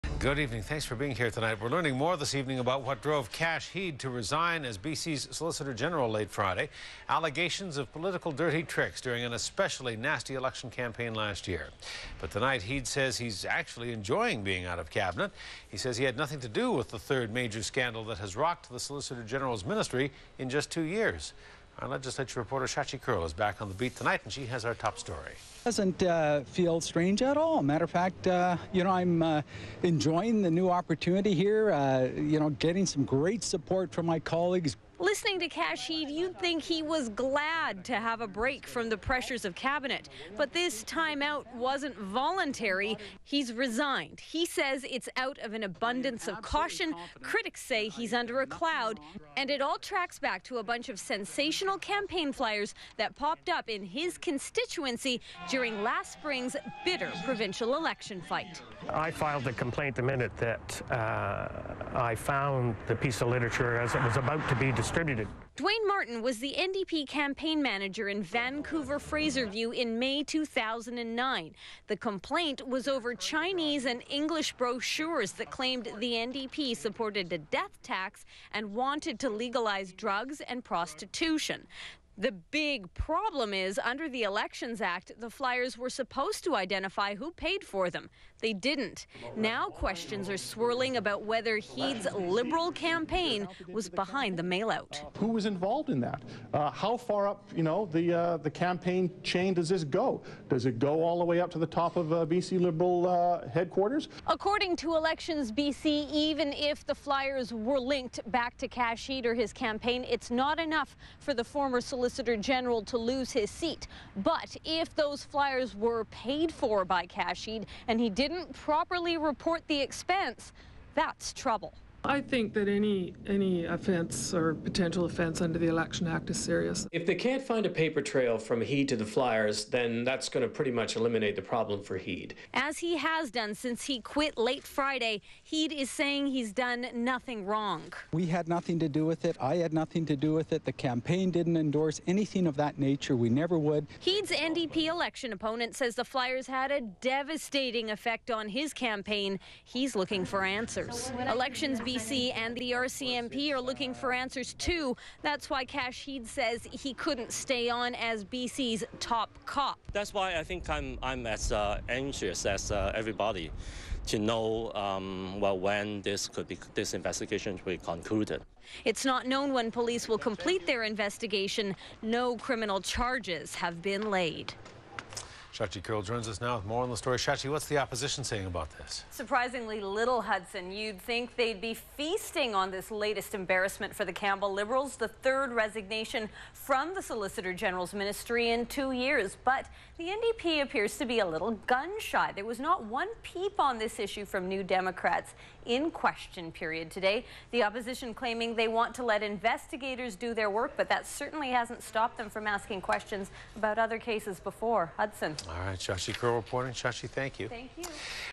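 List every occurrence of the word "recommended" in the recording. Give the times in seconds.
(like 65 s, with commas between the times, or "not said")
not said.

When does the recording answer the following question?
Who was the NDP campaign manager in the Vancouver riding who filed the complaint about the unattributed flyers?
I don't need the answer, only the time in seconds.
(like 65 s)
65 s.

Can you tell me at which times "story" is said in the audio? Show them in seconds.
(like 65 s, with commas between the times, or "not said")
24 s, 176 s.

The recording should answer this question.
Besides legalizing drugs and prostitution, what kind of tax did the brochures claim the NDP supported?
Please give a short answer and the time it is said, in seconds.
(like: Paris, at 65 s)
death tax, at 77 s.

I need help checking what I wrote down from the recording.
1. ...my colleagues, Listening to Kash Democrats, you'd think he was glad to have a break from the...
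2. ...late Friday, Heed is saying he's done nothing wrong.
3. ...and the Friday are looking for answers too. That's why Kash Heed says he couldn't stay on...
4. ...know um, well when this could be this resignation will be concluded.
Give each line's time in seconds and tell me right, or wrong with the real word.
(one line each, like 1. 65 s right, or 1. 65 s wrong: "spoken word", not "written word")
1. 34 s wrong: "Heed", not "Democrats"
2. 134 s right
3. 152 s wrong: "RCMP", not "Friday"
4. 164 s wrong: "investigation", not "resignation".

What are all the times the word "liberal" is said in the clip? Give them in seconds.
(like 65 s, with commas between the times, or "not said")
92 s, 102 s, 184 s.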